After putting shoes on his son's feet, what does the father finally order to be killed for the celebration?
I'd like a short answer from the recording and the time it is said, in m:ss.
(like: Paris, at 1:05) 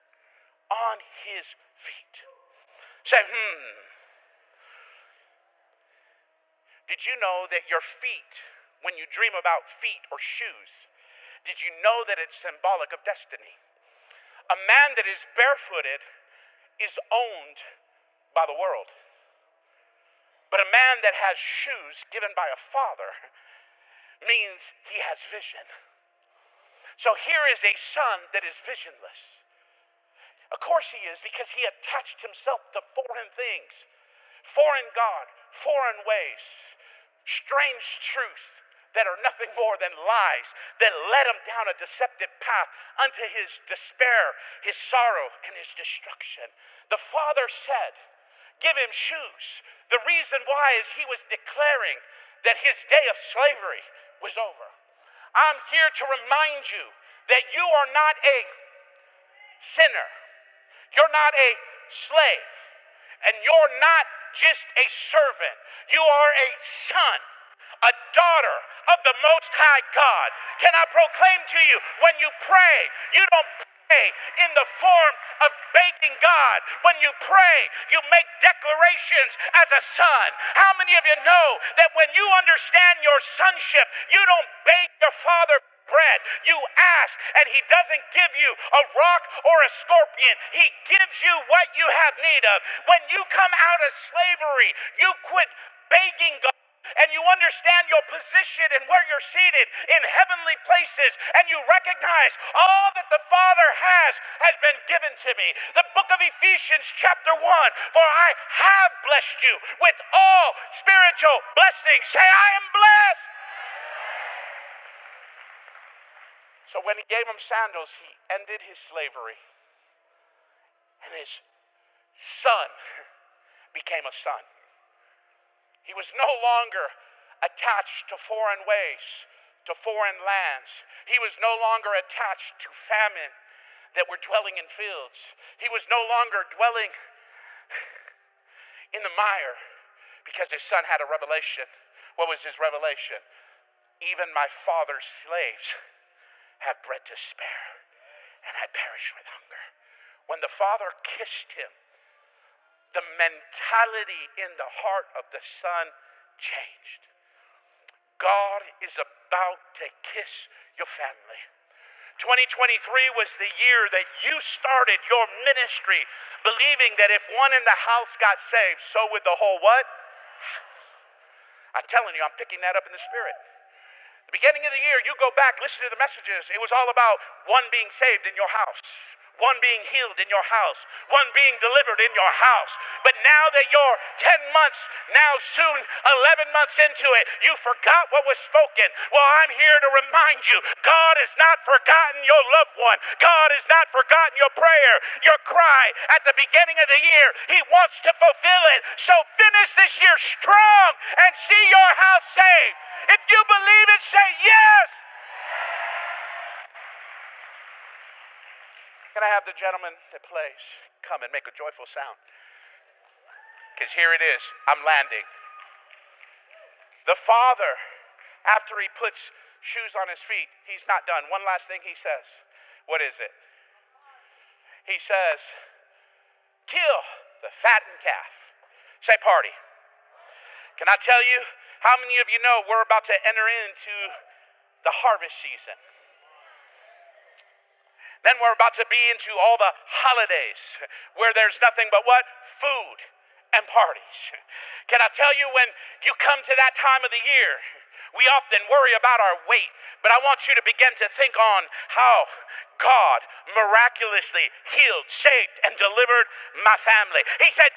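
The fattened calf, at 3:47.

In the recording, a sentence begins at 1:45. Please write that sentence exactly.
The book of Ephesians, chapter 1 For I have blessed you with all spiritual blessings.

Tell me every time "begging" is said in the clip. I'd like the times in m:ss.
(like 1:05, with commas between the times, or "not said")
1:15, 1:35.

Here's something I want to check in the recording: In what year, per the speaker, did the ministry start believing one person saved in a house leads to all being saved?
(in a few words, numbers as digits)
2023.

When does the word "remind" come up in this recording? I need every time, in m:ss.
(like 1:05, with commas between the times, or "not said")
0:56, 3:09.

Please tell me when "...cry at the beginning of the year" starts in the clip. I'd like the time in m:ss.
3:15.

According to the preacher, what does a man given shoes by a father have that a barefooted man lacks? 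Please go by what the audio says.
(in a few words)
Vision.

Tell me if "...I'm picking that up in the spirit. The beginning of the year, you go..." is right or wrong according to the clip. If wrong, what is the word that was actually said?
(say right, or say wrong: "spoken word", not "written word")
right.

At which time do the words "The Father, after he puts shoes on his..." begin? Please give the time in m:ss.
3:37.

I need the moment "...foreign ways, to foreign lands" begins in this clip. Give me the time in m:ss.
2:08.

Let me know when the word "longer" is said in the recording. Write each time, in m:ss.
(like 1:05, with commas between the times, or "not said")
2:06, 2:11, 2:16.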